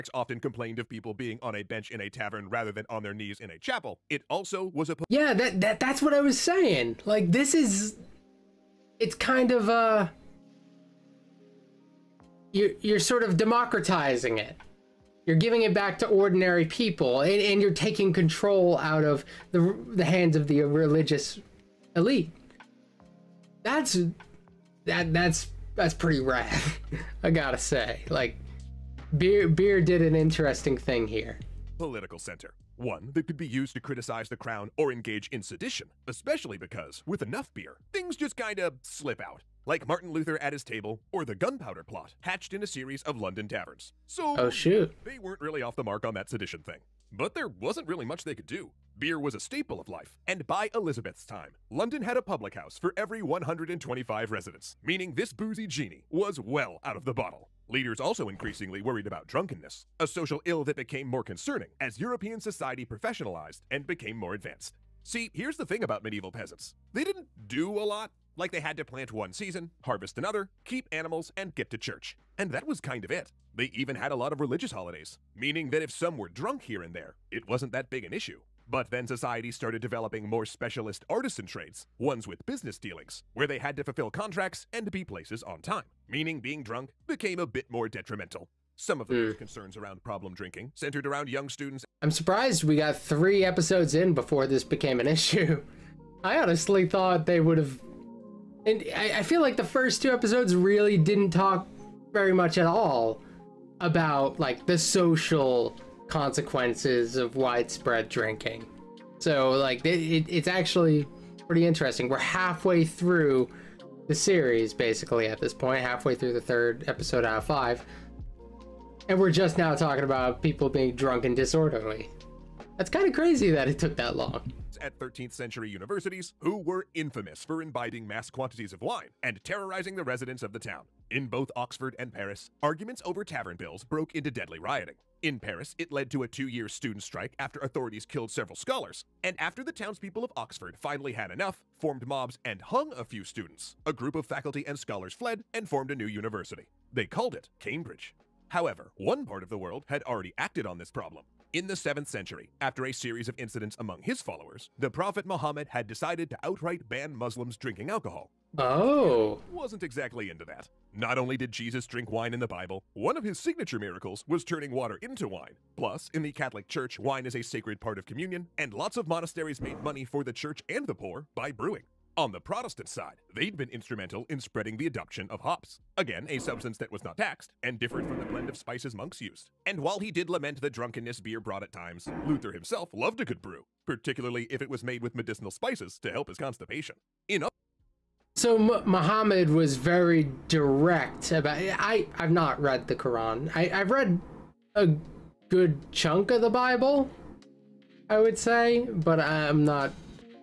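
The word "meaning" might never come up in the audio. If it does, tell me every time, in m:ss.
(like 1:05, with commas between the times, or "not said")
0:54, 1:15, 1:26.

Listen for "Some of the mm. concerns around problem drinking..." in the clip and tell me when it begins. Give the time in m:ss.
1:28.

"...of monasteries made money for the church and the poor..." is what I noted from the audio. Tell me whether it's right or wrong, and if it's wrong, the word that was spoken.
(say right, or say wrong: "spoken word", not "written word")
right.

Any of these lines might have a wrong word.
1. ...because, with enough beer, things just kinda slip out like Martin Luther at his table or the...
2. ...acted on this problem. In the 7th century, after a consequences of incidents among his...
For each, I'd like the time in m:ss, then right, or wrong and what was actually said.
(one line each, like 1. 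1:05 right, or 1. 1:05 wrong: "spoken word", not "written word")
1. 0:36 right
2. 2:30 wrong: "series", not "consequences".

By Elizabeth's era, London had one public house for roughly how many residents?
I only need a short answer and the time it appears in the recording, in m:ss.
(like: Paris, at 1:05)
125, at 0:53.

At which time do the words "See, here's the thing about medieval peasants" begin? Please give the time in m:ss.
1:05.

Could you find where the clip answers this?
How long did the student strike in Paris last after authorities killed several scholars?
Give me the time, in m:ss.
2:16.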